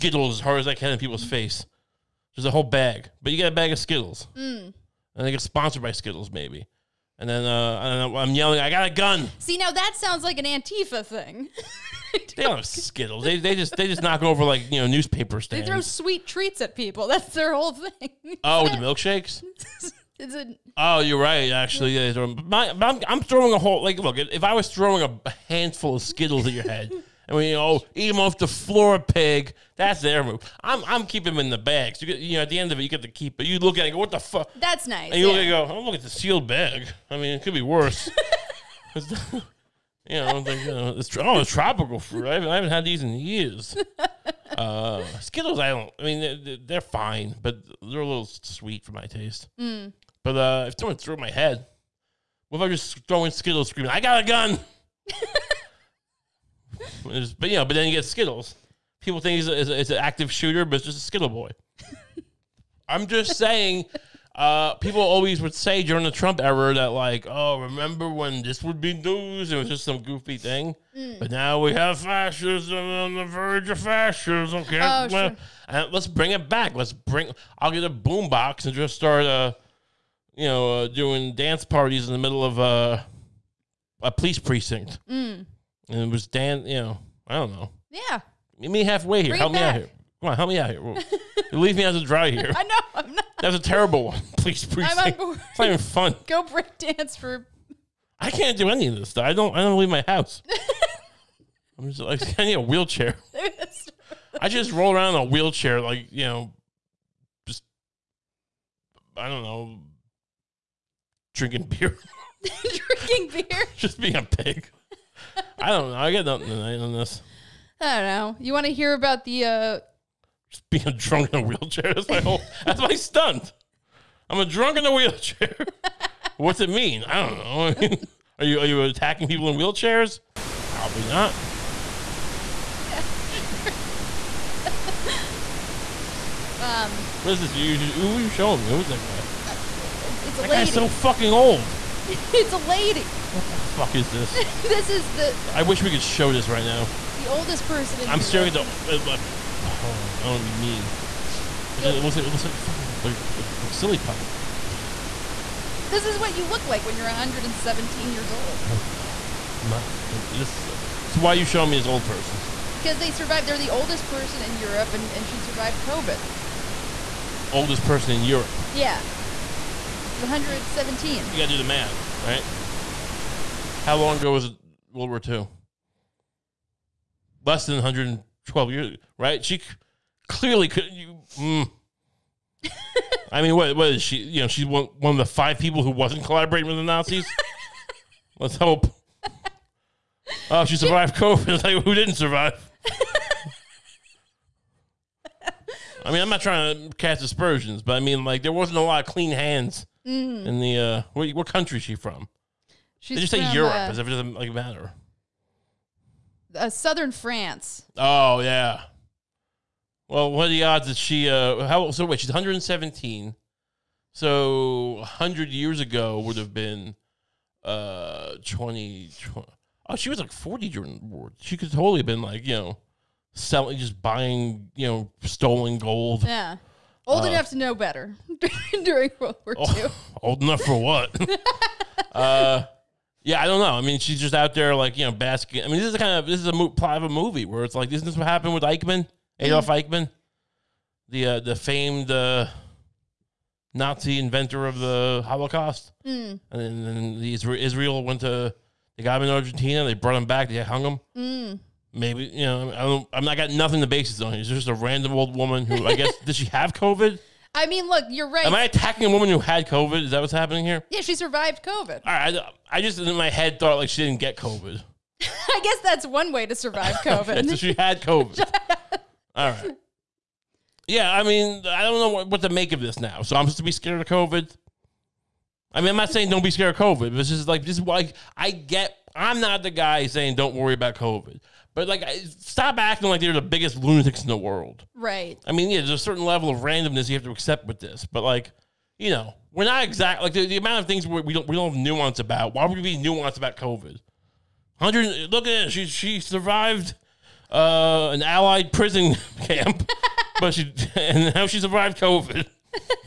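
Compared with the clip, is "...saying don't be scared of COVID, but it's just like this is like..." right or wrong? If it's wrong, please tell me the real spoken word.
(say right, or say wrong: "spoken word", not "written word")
right.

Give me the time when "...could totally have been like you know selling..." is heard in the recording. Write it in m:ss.
3:41.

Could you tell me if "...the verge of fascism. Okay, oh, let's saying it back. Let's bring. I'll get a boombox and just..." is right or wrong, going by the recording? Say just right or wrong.
wrong.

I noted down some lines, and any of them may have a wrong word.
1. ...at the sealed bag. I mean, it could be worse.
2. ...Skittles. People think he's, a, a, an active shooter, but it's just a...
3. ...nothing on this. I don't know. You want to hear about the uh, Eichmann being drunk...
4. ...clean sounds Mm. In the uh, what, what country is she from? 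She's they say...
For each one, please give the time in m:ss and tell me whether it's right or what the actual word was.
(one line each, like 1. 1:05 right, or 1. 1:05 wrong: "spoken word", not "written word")
1. 0:35 right
2. 0:58 right
3. 1:56 wrong: "Just", not "Eichmann"
4. 3:19 wrong: "hands", not "sounds".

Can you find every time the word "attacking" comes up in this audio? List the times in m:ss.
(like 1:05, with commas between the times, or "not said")
2:08, 4:18.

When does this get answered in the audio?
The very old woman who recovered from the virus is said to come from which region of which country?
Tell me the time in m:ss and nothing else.
3:26.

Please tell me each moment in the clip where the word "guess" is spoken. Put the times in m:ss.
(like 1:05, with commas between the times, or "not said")
4:15, 4:25.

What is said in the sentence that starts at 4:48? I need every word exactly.
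But like, you know, we're not exact.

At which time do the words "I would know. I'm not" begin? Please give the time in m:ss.
2:38.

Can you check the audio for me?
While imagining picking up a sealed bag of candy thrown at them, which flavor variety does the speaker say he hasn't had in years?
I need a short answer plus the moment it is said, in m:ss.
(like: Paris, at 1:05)
Tropical fruit, at 0:41.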